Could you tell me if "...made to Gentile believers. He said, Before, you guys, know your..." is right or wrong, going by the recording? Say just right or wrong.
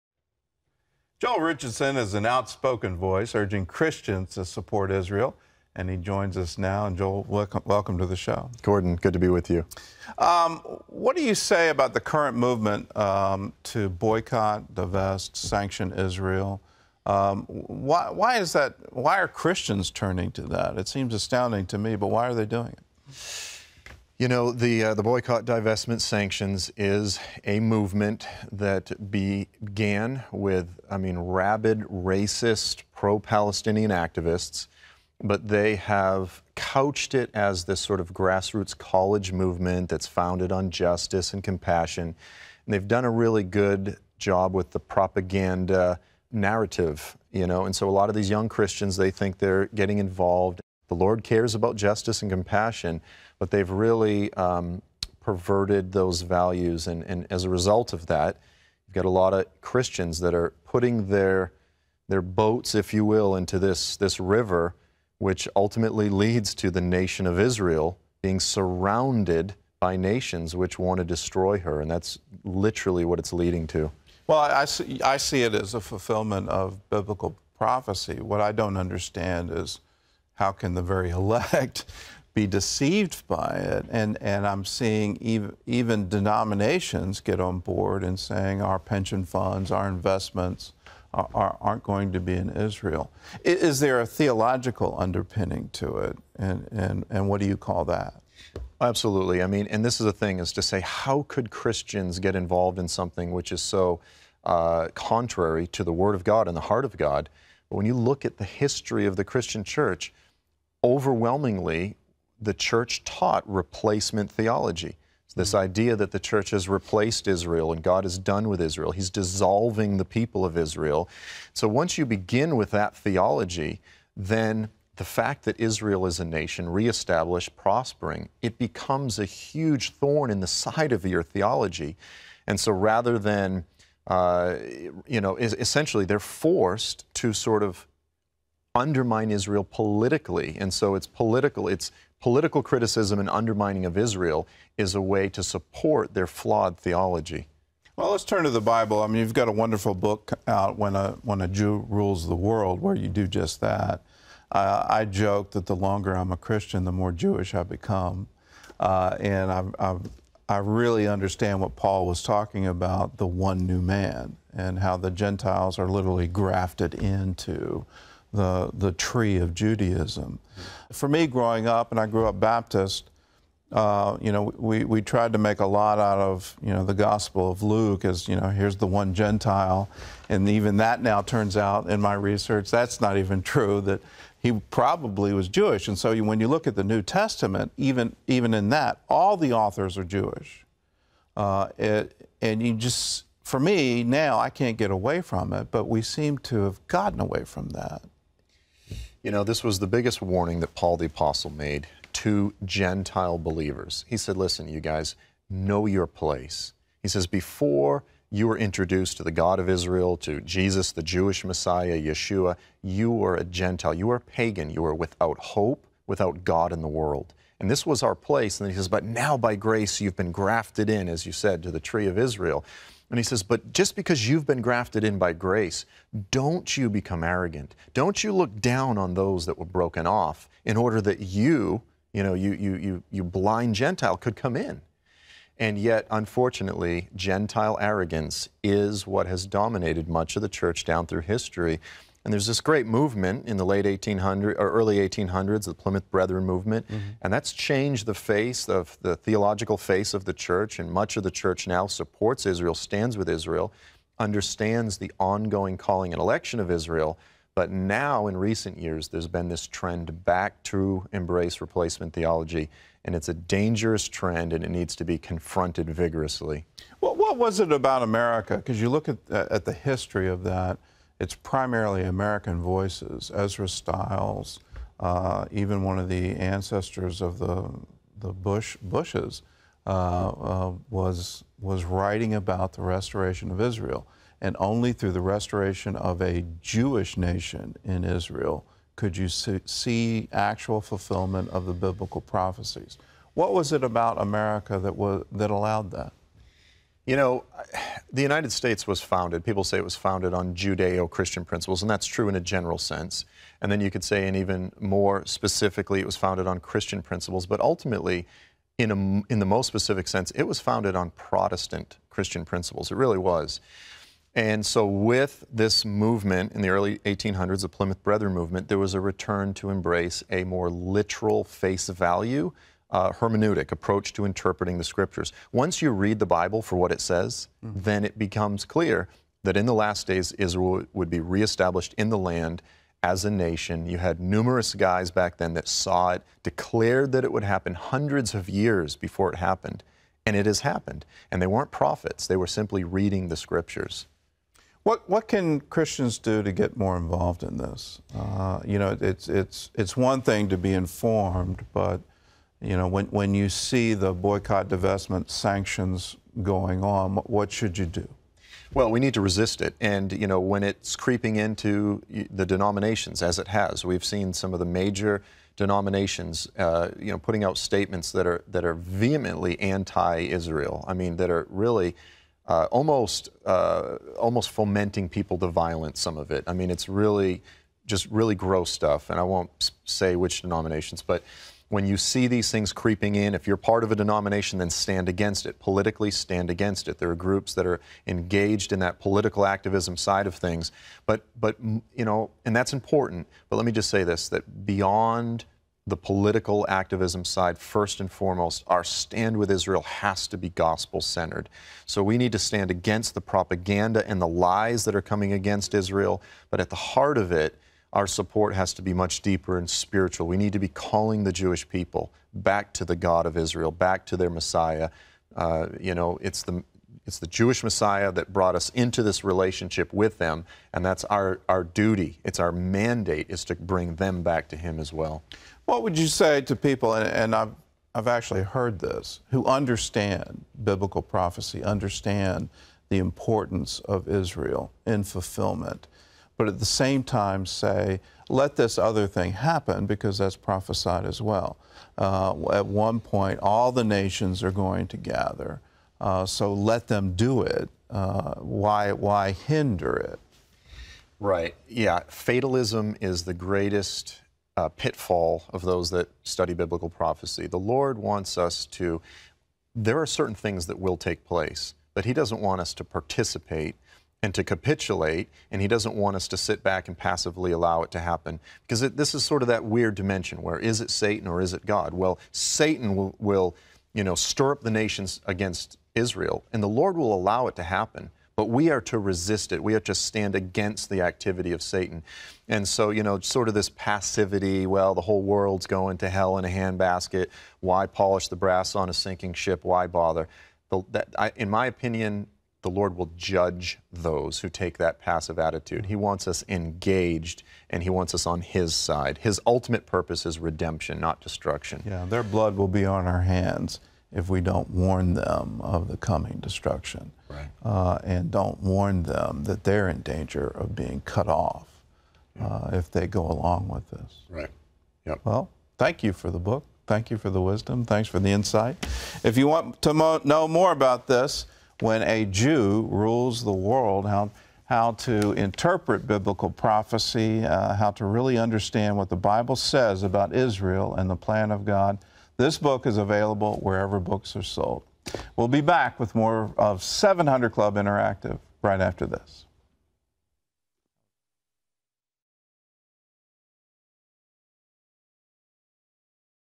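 wrong.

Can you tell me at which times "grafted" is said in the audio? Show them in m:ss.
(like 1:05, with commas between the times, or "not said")
2:46, 3:40, 3:44.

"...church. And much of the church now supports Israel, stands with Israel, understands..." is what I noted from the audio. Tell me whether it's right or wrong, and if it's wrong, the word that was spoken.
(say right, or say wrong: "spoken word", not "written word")
right.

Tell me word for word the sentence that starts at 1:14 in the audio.
Well, I see, I see it as a fulfillment of biblical prophecy.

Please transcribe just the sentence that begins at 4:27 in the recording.
Well, what was it about America?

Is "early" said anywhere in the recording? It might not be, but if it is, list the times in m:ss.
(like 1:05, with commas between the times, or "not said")
4:04, 5:16.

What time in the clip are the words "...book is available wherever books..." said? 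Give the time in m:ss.
8:52.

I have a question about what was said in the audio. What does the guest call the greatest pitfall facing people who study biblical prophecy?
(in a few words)
Fatalism.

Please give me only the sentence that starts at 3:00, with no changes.
And even that now turns out in my research, that's not even true, that he probably was Jewish.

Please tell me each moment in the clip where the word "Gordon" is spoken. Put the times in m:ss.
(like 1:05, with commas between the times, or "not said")
0:08.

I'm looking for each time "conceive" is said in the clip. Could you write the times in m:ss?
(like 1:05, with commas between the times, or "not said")
not said.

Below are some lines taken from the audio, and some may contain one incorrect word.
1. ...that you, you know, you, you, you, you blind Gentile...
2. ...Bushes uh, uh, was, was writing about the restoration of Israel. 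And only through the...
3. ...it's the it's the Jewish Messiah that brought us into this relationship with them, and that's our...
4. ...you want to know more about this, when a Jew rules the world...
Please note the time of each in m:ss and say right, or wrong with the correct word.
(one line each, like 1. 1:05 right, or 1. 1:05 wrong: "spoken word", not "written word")
1. 3:51 right
2. 4:38 right
3. 6:56 right
4. 8:39 right.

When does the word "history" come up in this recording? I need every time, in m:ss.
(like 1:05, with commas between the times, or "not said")
1:48, 4:01, 4:29.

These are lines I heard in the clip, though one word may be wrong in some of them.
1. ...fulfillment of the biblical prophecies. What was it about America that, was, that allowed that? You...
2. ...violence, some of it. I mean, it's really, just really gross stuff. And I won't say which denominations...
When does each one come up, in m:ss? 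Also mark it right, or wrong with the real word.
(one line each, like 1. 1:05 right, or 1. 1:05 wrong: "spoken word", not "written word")
1. 4:50 right
2. 6:15 right.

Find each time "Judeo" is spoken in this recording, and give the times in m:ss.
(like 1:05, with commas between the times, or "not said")
5:00.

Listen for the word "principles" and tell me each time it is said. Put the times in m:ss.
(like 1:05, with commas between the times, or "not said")
5:01, 5:07, 5:12.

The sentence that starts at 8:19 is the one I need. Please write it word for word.
His ultimate purpose is redemption, not destruction.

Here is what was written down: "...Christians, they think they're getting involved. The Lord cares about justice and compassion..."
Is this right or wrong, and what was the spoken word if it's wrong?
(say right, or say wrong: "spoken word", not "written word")
right.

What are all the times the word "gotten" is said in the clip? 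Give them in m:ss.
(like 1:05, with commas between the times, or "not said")
3:16.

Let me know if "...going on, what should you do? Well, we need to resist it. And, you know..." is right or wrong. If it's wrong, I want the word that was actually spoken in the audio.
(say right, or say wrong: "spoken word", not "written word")
right.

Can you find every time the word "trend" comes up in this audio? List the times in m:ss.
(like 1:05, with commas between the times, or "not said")
4:19, 4:24.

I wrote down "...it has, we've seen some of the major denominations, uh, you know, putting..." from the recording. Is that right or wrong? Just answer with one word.
right.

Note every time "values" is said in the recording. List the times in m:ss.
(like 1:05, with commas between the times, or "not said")
0:56, 5:21.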